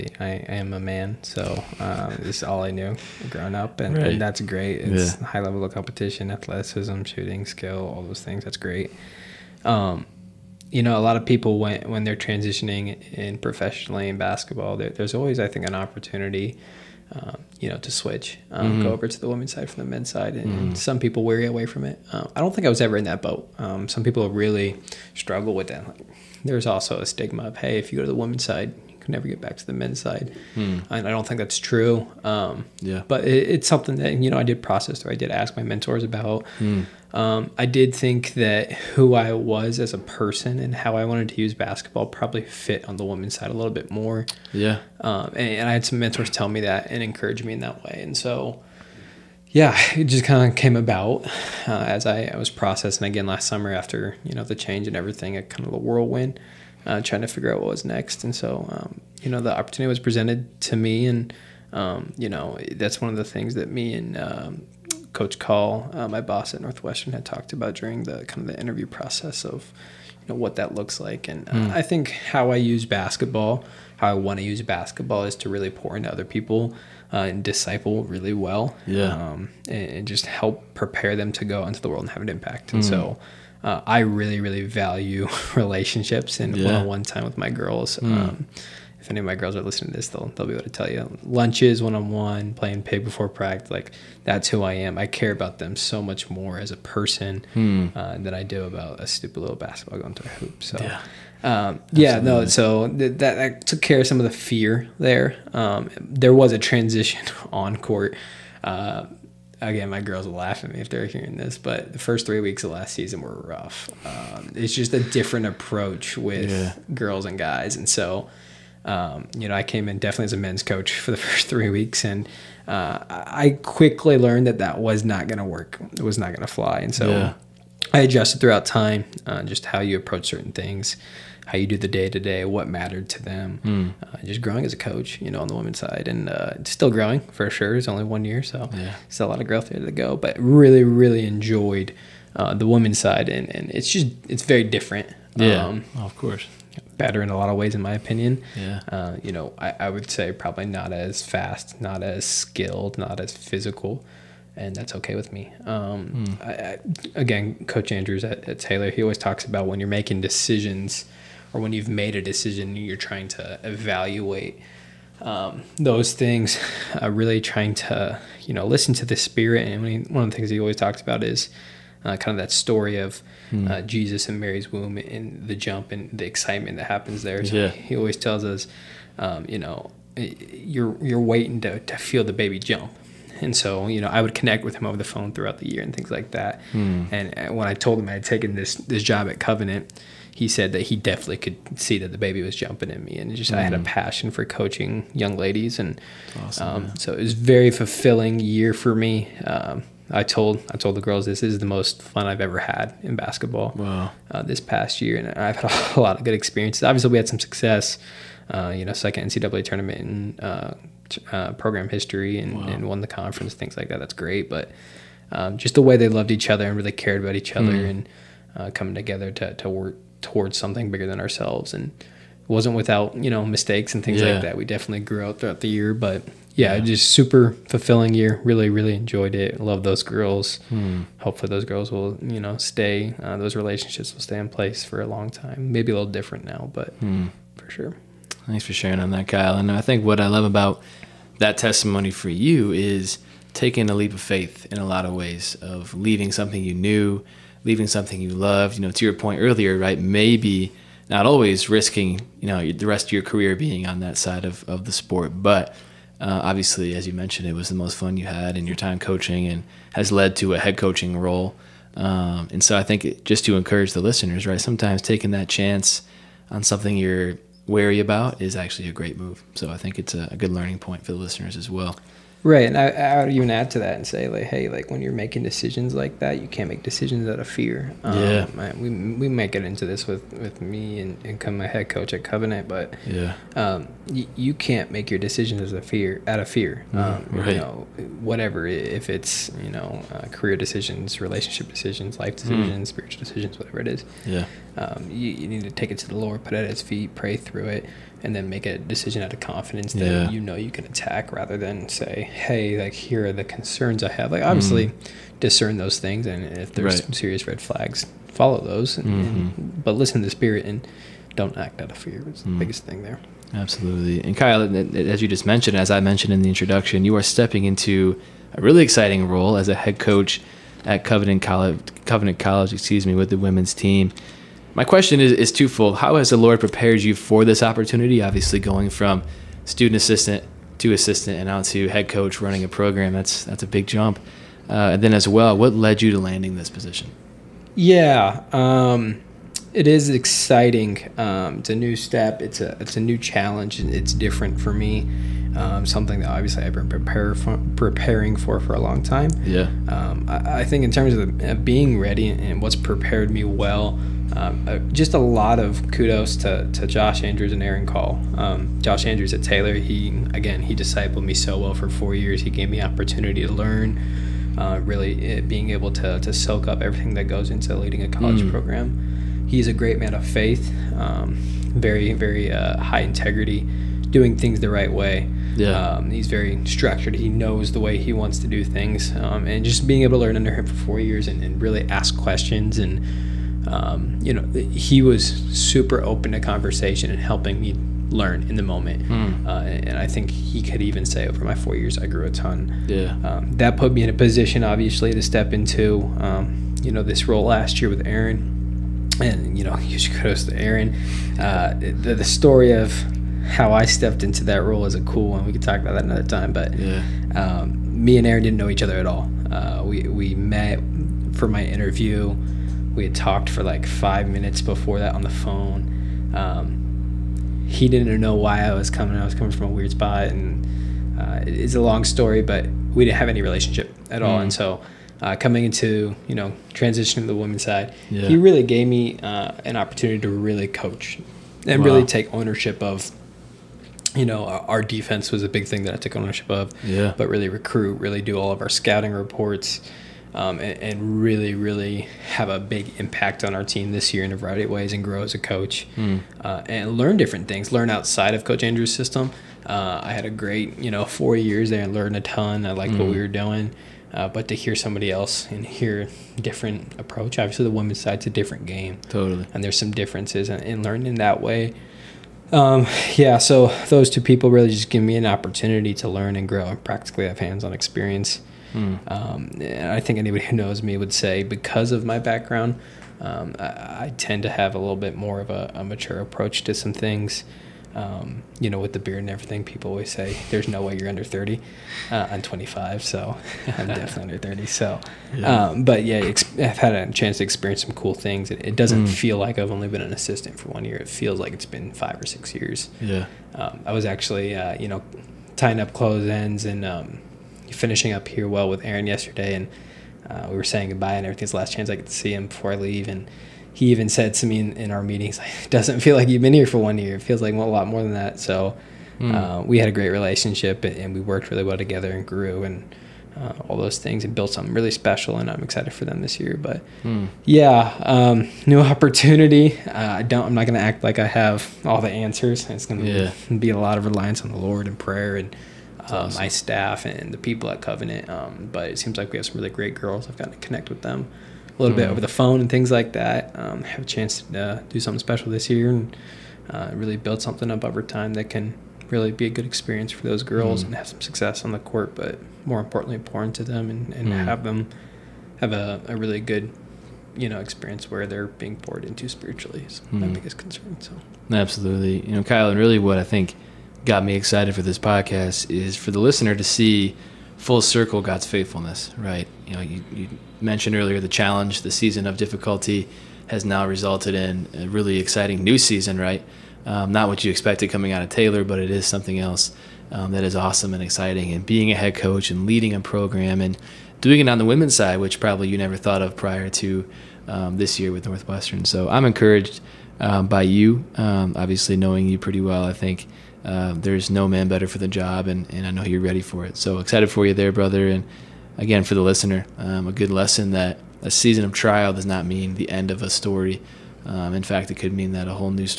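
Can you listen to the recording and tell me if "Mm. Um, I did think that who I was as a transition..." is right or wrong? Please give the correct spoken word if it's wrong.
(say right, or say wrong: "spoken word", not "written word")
wrong: "person", not "transition".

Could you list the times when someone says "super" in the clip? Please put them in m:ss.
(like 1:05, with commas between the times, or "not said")
3:47, 6:25.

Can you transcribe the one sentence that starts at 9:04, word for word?
have them have a, a really good, you know, experience where they're being poured into spiritually.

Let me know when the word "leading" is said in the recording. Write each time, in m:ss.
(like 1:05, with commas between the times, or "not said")
6:07, 9:32.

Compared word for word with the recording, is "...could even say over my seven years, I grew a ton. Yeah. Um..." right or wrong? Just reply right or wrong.
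wrong.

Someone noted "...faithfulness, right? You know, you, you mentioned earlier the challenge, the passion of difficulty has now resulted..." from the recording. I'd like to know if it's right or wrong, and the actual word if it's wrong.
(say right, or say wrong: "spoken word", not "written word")
wrong: "season", not "passion".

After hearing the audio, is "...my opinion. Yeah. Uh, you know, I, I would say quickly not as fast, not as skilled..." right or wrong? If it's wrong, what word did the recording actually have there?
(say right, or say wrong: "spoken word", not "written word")
wrong: "probably", not "quickly".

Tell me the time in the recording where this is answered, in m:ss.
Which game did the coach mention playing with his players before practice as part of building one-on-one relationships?
1:32.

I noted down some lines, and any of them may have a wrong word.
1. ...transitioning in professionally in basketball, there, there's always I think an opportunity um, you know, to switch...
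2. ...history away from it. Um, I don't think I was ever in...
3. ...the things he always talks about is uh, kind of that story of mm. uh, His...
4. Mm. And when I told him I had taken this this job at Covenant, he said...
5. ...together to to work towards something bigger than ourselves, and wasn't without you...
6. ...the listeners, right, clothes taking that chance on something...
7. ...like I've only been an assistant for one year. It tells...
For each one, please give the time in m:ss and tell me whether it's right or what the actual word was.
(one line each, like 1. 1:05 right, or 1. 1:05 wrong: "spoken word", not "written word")
1. 0:12 right
2. 0:21 wrong: "weary", not "history"
3. 2:50 wrong: "Jesus", not "His"
4. 3:06 right
5. 3:38 right
6. 4:23 wrong: "sometimes", not "clothes"
7. 8:09 wrong: "feels", not "tells".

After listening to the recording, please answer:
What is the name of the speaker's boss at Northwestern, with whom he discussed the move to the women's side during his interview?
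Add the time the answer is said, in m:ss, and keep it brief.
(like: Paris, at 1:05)
Aaron Call, at 1:05.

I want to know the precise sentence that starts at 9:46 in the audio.
So excited for you there, brother.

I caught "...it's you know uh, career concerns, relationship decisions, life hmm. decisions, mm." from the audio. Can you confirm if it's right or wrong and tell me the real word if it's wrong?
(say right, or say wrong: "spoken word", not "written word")
wrong: "decisions", not "concerns".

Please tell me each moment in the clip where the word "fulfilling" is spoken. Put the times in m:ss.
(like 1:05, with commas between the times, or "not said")
3:17, 3:47.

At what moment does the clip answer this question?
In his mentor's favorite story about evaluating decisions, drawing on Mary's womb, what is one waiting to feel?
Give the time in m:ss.
3:01.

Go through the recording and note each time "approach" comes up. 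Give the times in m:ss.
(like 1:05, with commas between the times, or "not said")
1:55, 2:09, 7:36, 7:56.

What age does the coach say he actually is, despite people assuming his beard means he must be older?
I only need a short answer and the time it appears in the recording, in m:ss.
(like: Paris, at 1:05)
25, at 8:02.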